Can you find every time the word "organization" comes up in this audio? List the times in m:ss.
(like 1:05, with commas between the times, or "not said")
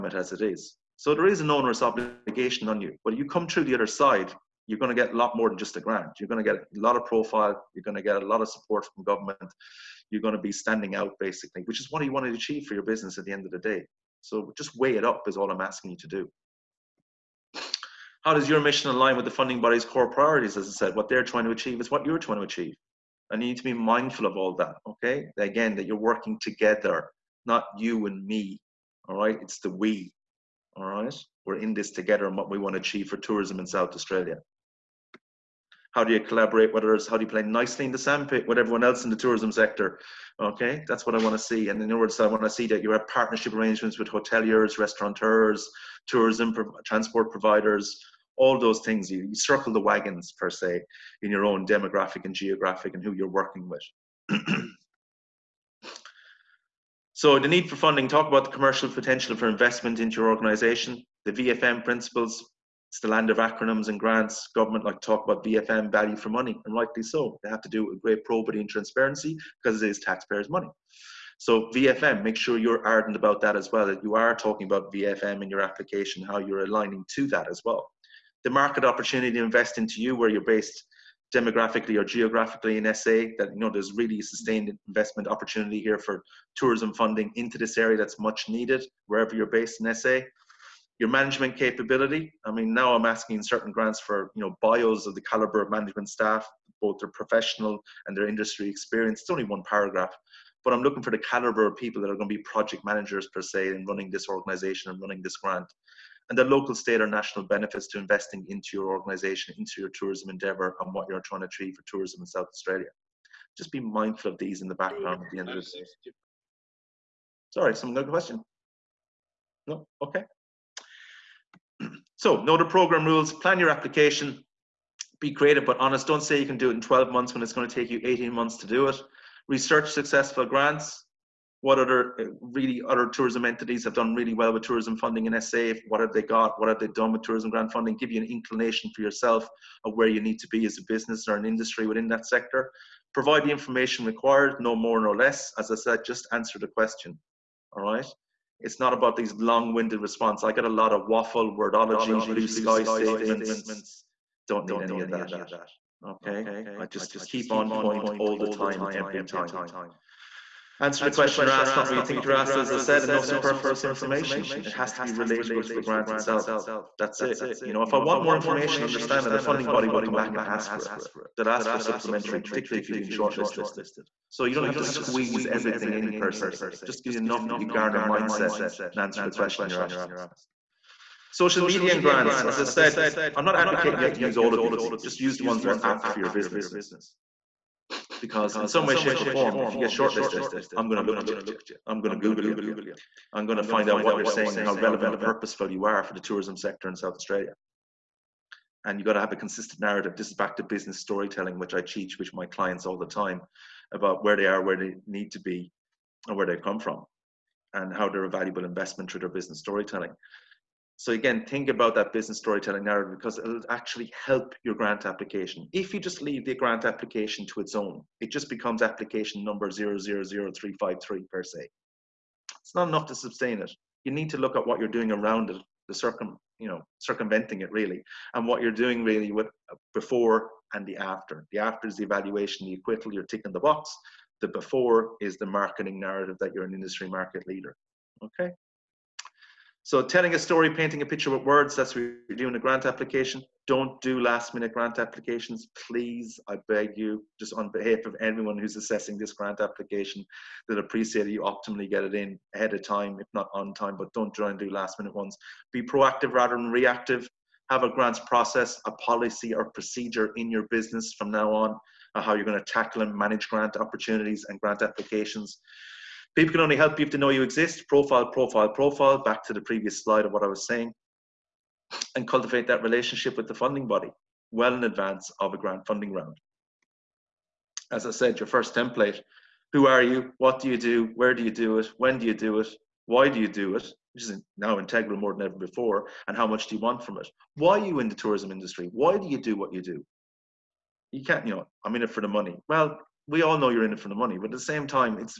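1:00, 1:44, 1:48.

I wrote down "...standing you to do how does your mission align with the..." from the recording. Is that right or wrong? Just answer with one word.
wrong.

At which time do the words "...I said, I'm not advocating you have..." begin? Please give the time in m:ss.
3:02.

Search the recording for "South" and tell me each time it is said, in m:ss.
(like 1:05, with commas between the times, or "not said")
0:33, 1:52, 3:16.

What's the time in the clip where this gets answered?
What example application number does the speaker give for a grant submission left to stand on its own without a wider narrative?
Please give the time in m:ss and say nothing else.
3:39.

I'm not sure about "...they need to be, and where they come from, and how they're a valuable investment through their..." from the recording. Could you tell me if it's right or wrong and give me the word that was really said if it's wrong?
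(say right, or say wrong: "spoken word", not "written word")
right.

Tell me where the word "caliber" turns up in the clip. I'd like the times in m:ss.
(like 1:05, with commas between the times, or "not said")
1:35, 1:41.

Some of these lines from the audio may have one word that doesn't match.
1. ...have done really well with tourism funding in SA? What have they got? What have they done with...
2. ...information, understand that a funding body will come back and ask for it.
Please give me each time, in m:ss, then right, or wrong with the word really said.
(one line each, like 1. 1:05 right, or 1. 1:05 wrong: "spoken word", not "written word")
1. 2:13 right
2. 2:48 right.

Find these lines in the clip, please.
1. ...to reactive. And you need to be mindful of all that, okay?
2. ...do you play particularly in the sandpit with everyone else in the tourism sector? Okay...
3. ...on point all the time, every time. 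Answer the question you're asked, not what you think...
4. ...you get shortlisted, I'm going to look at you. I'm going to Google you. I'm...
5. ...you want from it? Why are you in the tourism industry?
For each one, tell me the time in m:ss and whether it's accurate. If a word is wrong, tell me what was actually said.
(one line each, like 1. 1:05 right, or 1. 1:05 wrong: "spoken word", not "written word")
1. 0:22 wrong: "achieve", not "reactive"
2. 0:37 wrong: "nicely", not "particularly"
3. 2:37 right
4. 3:09 right
5. 4:46 right.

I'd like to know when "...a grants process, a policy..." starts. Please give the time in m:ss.
4:17.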